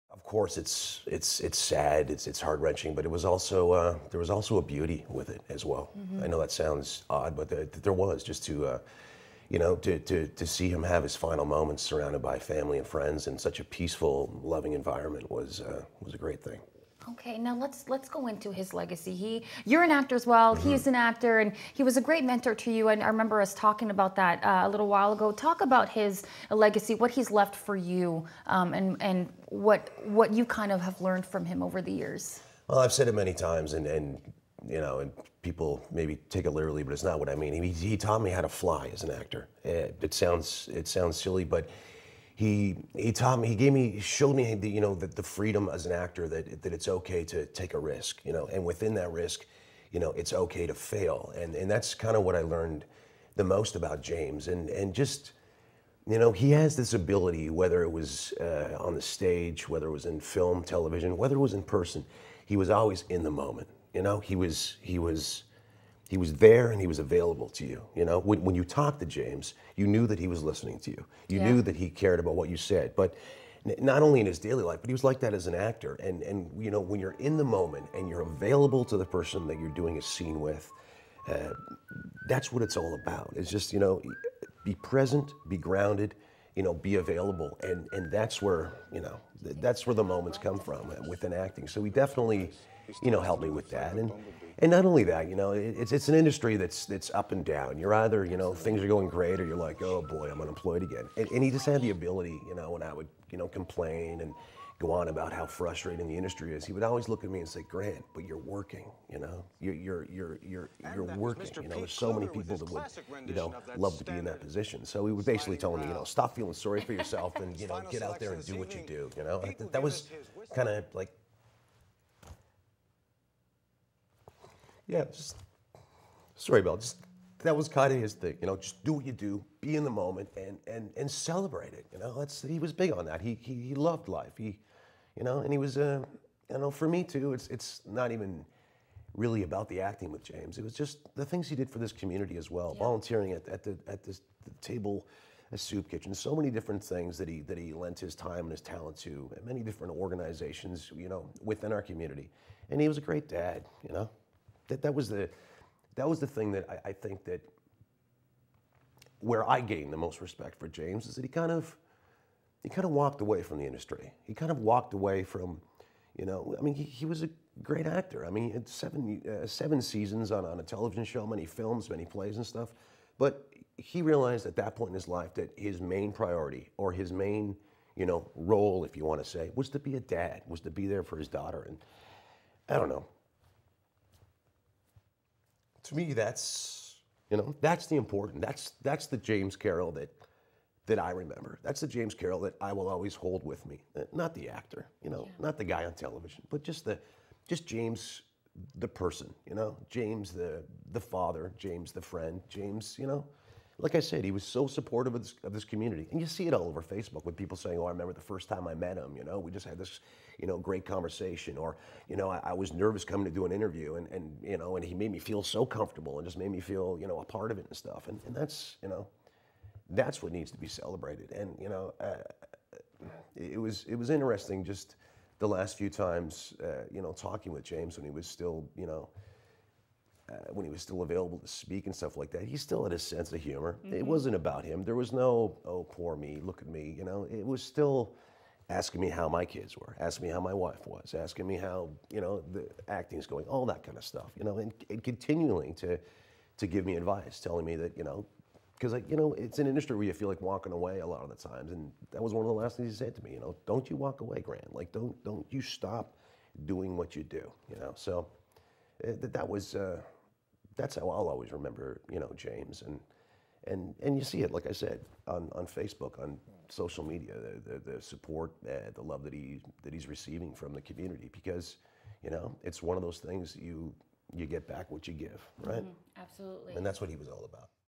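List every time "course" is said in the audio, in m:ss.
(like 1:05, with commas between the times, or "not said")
0:00.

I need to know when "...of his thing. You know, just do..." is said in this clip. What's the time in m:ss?
2:07.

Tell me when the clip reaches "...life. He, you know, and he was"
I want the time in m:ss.
2:14.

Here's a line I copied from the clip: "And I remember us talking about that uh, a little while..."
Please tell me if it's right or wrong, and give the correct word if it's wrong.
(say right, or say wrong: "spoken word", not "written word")
right.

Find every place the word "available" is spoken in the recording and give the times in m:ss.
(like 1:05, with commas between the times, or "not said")
1:06, 1:18, 1:26, 3:51.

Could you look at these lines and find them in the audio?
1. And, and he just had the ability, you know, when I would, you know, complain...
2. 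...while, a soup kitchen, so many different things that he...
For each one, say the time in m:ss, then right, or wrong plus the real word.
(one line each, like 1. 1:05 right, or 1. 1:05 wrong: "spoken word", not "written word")
1. 1:41 right
2. 2:24 wrong: "table", not "while".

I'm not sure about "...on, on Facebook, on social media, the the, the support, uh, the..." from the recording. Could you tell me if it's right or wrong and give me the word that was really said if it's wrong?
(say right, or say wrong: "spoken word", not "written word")
right.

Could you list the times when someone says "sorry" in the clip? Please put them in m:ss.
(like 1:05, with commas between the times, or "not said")
1:56, 2:06.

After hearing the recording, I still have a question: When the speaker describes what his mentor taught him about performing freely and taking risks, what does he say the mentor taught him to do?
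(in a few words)
How to fly.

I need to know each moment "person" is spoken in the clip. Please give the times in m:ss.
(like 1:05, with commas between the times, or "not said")
1:01, 1:19, 3:18.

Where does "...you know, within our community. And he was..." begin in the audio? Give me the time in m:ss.
2:30.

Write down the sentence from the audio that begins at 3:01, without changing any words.
And I don't know to me, that's you know that's the important.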